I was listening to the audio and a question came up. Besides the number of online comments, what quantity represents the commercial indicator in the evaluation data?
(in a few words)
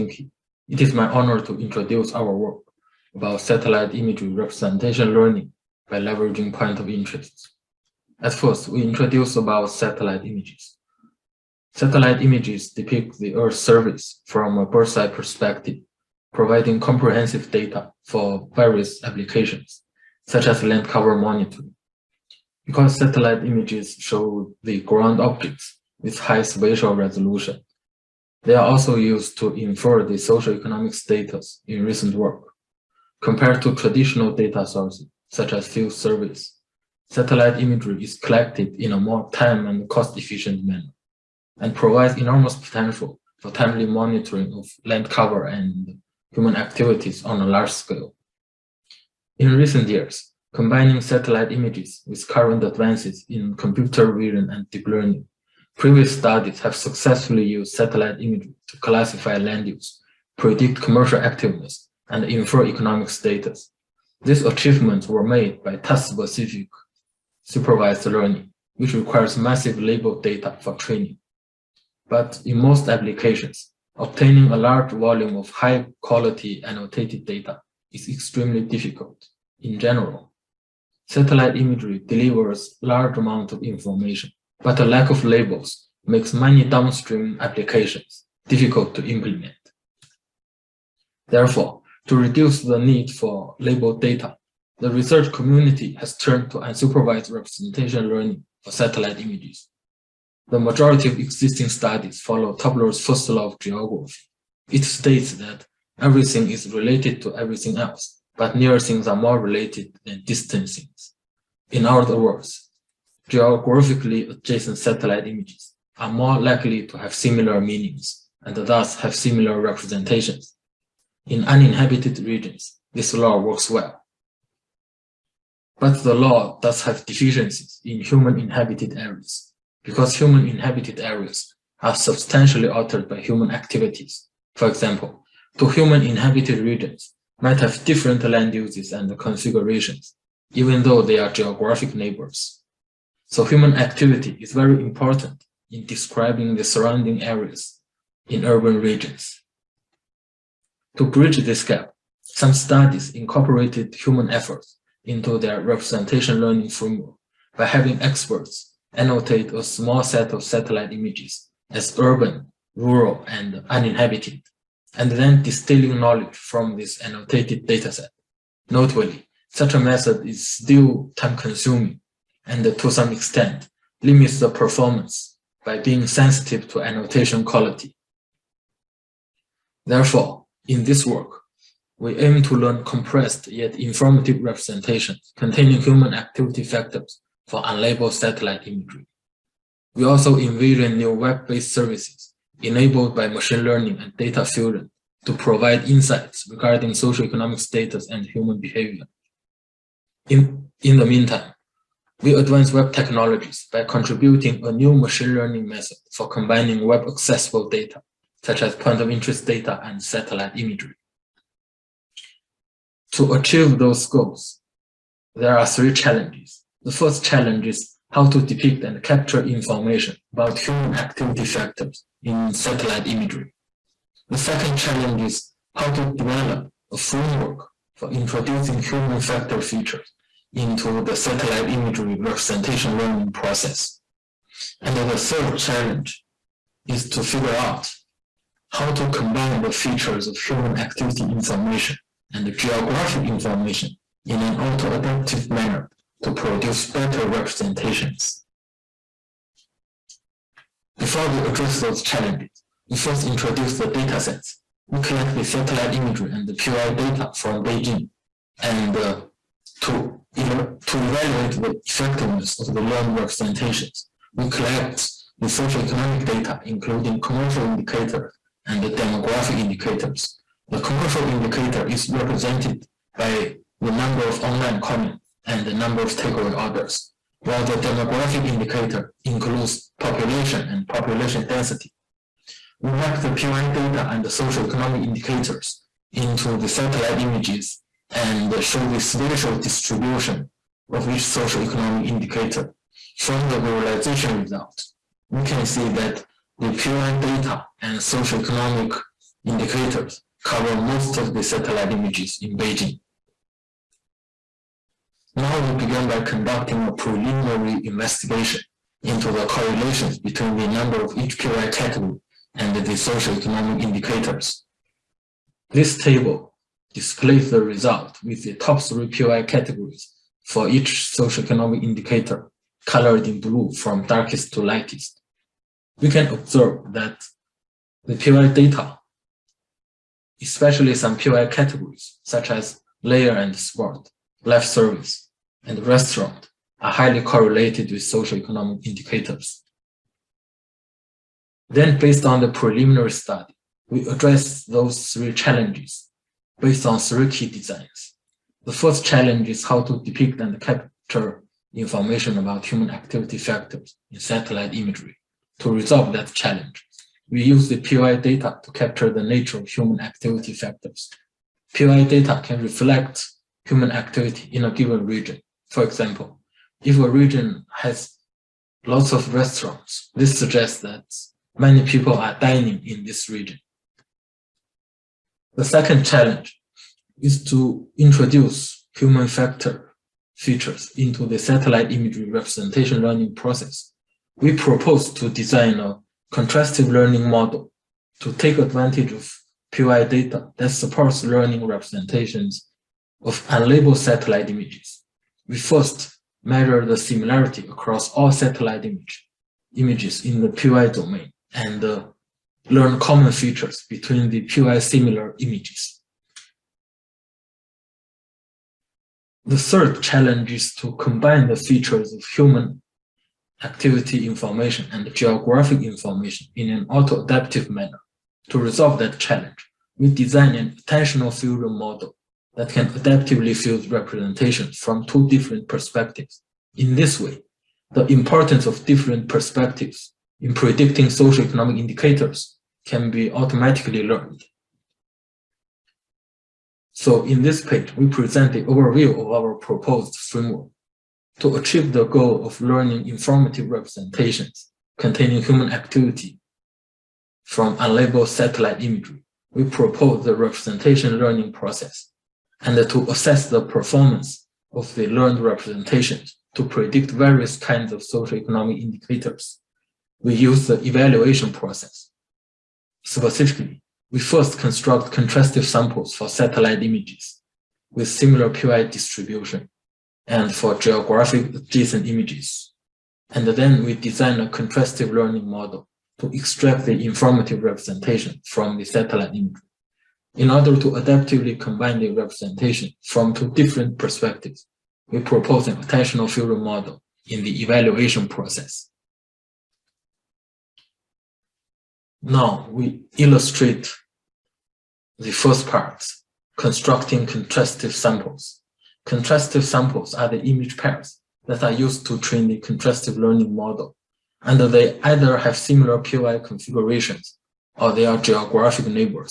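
number of takeaway orders.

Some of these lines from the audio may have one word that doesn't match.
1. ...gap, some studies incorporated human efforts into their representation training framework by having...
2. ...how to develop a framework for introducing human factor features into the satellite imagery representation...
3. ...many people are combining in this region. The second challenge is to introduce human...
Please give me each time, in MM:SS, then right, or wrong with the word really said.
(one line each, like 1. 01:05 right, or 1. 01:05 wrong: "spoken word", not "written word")
1. 02:31 wrong: "learning", not "training"
2. 03:45 right
3. 06:11 wrong: "dining", not "combining".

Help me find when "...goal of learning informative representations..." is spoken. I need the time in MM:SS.
07:22.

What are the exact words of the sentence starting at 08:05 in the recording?
We propose an attentional fusion model in the evaluation process.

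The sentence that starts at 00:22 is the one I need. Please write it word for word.
Because satellite images show the ground objects, with high spatial resolution.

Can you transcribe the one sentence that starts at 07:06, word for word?
In this way, the importance of different perspectives in predicting socioeconomic indicators can be automatically learned.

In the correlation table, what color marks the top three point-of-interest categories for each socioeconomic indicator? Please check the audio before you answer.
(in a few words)
blue.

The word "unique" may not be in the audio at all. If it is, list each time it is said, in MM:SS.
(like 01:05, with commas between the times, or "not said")
not said.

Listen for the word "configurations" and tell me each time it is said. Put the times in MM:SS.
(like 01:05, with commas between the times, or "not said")
02:19, 08:26.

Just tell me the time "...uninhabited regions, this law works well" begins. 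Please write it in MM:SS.
02:01.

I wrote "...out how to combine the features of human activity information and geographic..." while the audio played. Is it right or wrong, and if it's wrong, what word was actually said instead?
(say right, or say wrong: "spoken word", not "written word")
right.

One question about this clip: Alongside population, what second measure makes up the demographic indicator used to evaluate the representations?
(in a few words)
population density.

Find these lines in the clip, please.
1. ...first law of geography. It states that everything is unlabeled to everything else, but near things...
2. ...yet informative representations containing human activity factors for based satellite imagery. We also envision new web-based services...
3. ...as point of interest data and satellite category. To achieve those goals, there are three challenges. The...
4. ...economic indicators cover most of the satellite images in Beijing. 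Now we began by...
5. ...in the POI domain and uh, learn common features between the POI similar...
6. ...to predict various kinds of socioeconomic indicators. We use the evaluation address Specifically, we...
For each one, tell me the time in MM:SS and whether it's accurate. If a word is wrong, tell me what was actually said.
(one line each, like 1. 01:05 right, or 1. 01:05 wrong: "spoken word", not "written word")
1. 01:43 wrong: "related", not "unlabeled"
2. 03:03 wrong: "unlabeled", not "based"
3. 03:28 wrong: "imagery", not "category"
4. 04:58 right
5. 06:40 right
6. 07:36 wrong: "process", not "address".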